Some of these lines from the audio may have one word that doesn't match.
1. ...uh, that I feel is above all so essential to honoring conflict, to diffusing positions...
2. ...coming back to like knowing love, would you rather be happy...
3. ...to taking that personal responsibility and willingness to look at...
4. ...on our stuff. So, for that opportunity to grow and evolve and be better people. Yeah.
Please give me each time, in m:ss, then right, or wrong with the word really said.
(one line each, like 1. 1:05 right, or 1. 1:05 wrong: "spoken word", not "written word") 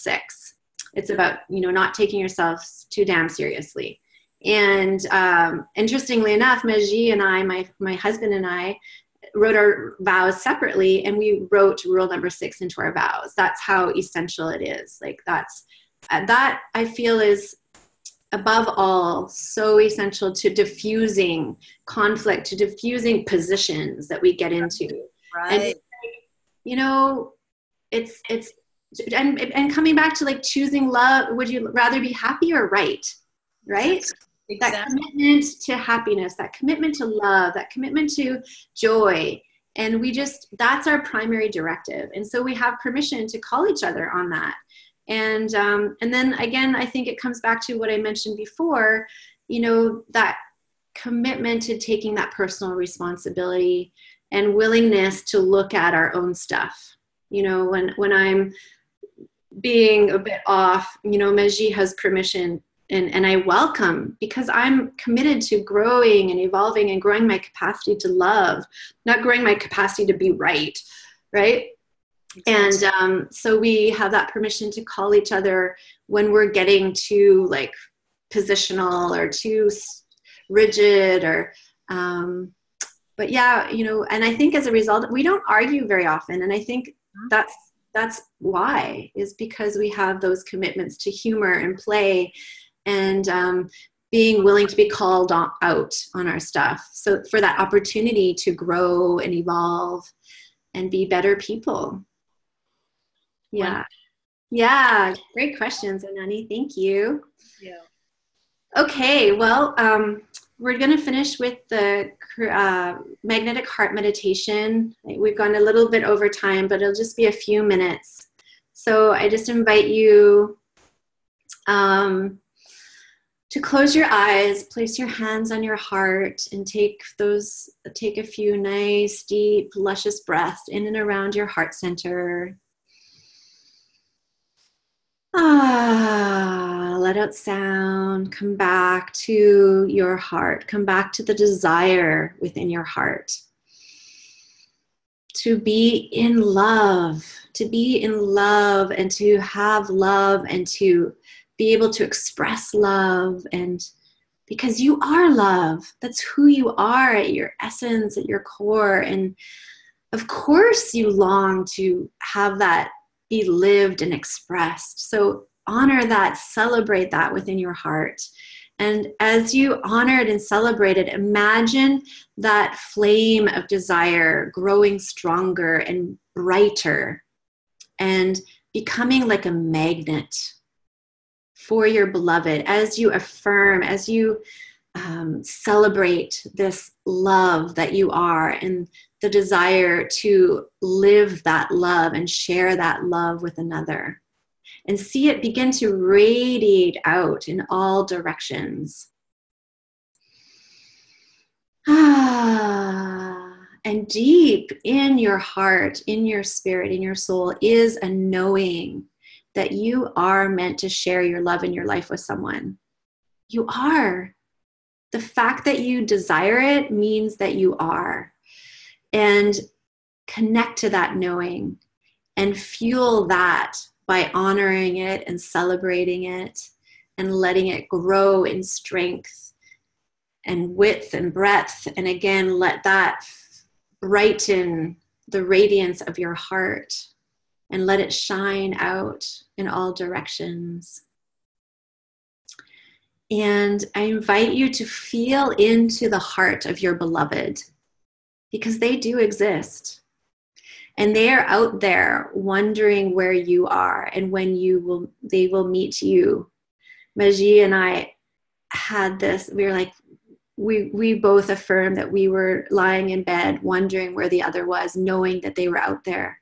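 1. 0:16 wrong: "diffusing", not "honoring"
2. 0:29 wrong: "choosing", not "knowing"
3. 0:51 right
4. 1:36 right.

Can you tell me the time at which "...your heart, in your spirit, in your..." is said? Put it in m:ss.
3:25.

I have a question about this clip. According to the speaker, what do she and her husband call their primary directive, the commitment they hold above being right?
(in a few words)
Happiness.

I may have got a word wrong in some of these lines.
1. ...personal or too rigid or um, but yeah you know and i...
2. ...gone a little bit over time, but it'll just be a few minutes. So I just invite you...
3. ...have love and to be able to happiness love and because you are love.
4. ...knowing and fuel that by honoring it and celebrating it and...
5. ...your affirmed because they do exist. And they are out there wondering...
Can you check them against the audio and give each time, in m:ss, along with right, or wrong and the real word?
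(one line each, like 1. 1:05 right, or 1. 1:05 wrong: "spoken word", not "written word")
1. 1:18 wrong: "positional", not "personal"
2. 1:55 right
3. 2:29 wrong: "express", not "happiness"
4. 3:41 right
5. 4:06 wrong: "beloved", not "affirmed".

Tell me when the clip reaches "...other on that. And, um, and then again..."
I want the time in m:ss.
0:43.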